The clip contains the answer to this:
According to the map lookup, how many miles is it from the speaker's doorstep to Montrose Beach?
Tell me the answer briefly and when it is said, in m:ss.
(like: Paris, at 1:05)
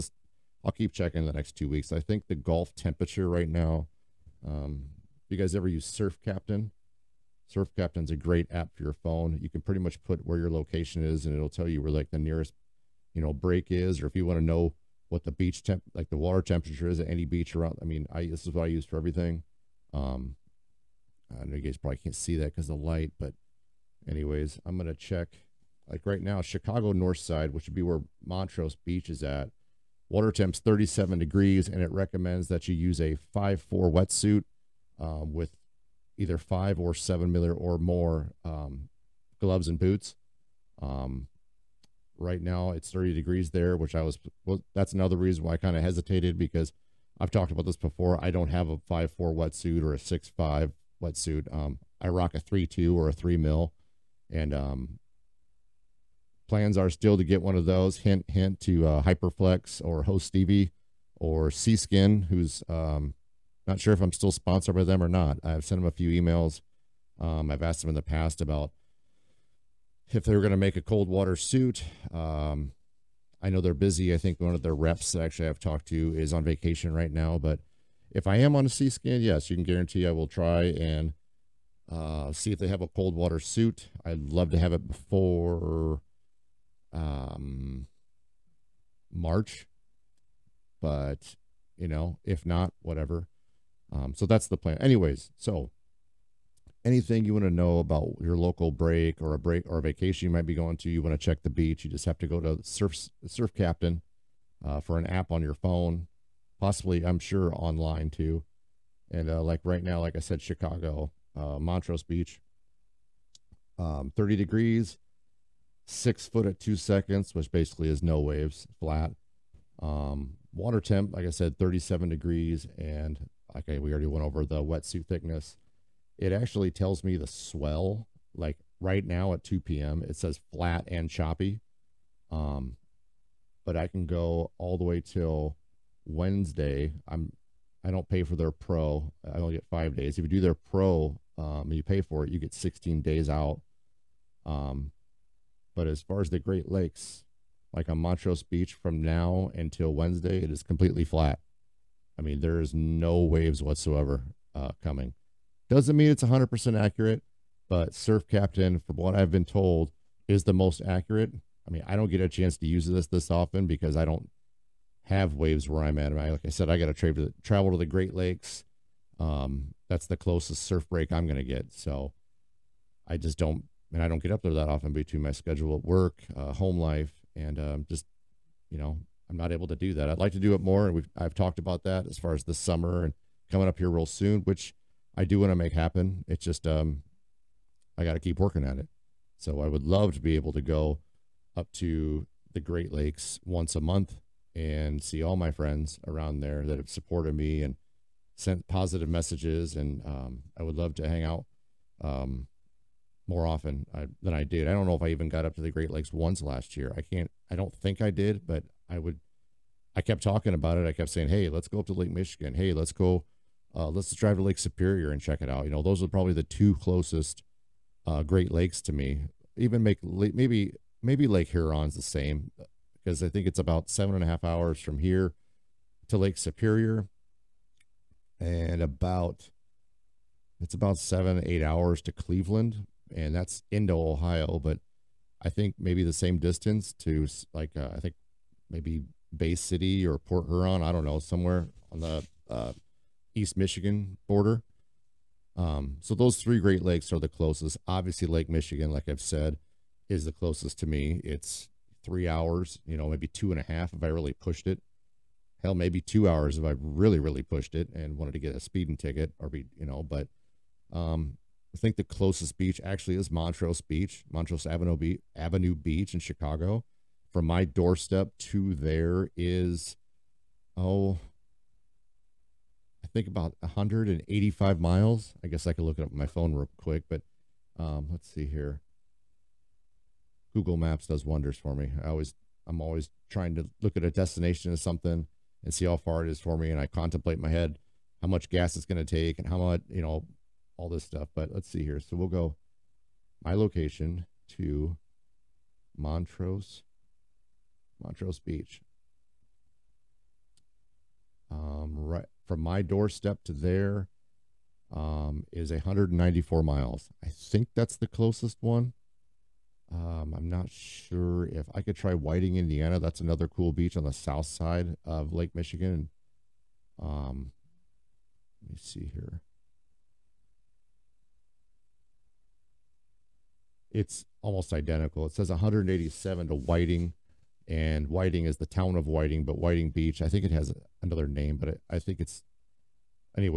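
194 miles, at 5:05.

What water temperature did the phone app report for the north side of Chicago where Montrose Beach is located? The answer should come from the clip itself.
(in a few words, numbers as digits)
37 degrees.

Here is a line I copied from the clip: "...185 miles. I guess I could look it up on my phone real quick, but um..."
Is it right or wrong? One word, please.
right.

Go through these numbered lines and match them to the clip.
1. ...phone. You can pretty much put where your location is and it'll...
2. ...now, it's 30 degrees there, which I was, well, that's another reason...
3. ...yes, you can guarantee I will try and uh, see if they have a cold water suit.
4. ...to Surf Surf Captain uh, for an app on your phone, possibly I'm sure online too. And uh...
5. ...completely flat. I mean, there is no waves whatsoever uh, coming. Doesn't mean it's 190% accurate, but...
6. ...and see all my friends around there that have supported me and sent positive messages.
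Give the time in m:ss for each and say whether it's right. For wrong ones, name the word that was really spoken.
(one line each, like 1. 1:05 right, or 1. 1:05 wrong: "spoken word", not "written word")
1. 0:08 right
2. 0:42 right
3. 1:19 right
4. 1:42 right
5. 2:30 wrong: "100", not "190"
6. 3:14 right.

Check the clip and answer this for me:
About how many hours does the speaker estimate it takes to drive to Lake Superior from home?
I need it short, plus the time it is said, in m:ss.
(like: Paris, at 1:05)
seven and a half hours, at 3:43.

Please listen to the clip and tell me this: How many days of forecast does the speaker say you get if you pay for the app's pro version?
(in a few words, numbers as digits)
16 days.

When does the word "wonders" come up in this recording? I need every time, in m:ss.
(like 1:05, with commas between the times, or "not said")
4:41.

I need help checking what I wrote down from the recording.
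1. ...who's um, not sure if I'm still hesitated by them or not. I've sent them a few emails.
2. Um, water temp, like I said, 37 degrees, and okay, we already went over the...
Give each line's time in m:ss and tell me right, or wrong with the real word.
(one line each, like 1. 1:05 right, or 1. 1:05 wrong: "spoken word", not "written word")
1. 1:02 wrong: "sponsored", not "hesitated"
2. 1:59 right.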